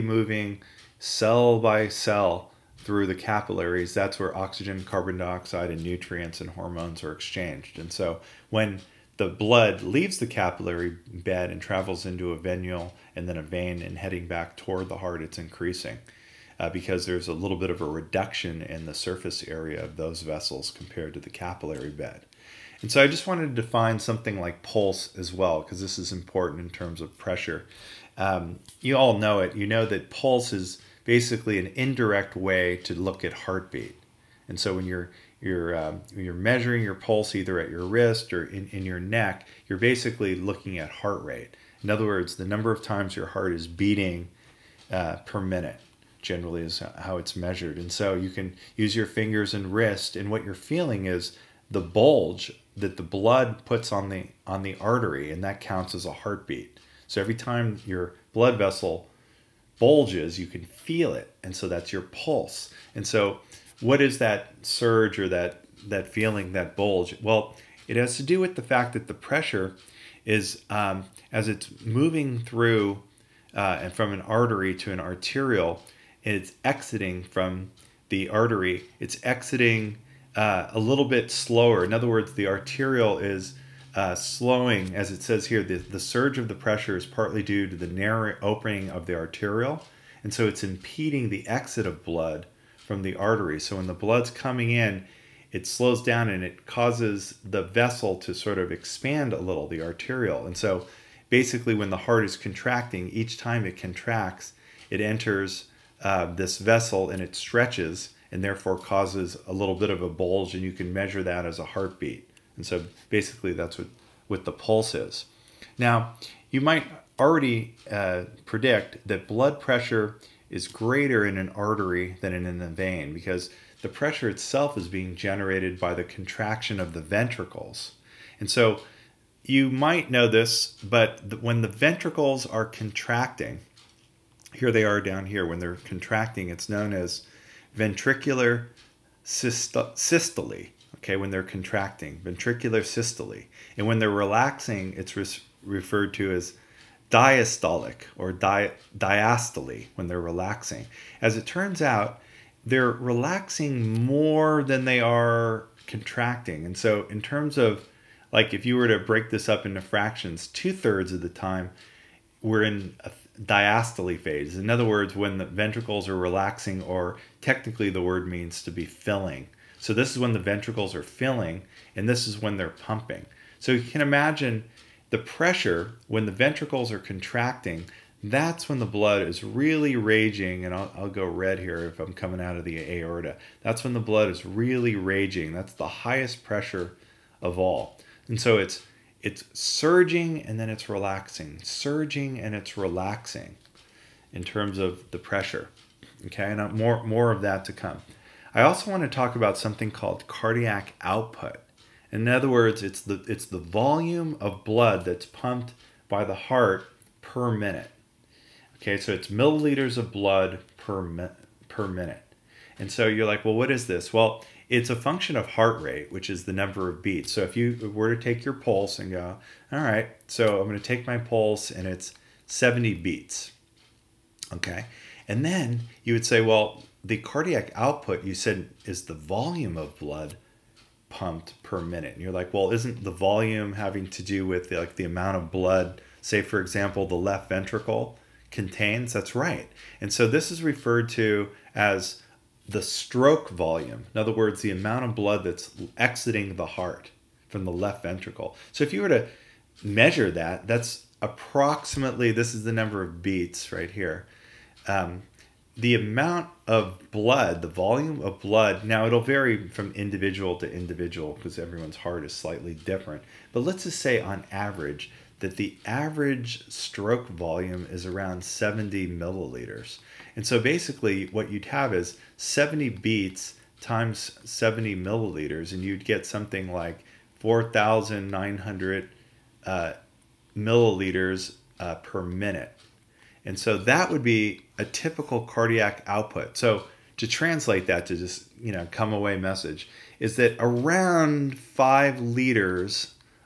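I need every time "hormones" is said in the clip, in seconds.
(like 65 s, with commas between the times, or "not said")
6 s.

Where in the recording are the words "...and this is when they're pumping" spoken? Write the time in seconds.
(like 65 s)
171 s.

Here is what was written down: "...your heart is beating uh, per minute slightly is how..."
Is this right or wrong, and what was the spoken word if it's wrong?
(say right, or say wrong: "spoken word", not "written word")
wrong: "generally", not "slightly".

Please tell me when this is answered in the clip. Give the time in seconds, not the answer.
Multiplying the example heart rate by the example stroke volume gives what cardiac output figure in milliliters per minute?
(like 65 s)
277 s.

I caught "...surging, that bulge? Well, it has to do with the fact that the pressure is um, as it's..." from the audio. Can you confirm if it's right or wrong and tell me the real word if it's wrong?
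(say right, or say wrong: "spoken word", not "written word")
wrong: "feeling", not "surging".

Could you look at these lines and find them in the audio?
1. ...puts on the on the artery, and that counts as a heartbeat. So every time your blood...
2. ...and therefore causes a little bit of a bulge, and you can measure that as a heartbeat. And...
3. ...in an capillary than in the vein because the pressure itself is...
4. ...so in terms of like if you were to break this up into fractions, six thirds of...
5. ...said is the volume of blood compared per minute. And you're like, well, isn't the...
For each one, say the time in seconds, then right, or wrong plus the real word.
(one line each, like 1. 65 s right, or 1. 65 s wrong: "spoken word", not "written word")
1. 53 s right
2. 108 s right
3. 121 s wrong: "artery", not "capillary"
4. 156 s wrong: "two", not "six"
5. 228 s wrong: "pumped", not "compared".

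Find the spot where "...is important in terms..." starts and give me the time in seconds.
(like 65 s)
25 s.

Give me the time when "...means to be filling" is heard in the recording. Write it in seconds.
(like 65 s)
168 s.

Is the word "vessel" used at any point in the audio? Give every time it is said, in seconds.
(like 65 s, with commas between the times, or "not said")
20 s, 58 s, 97 s, 106 s.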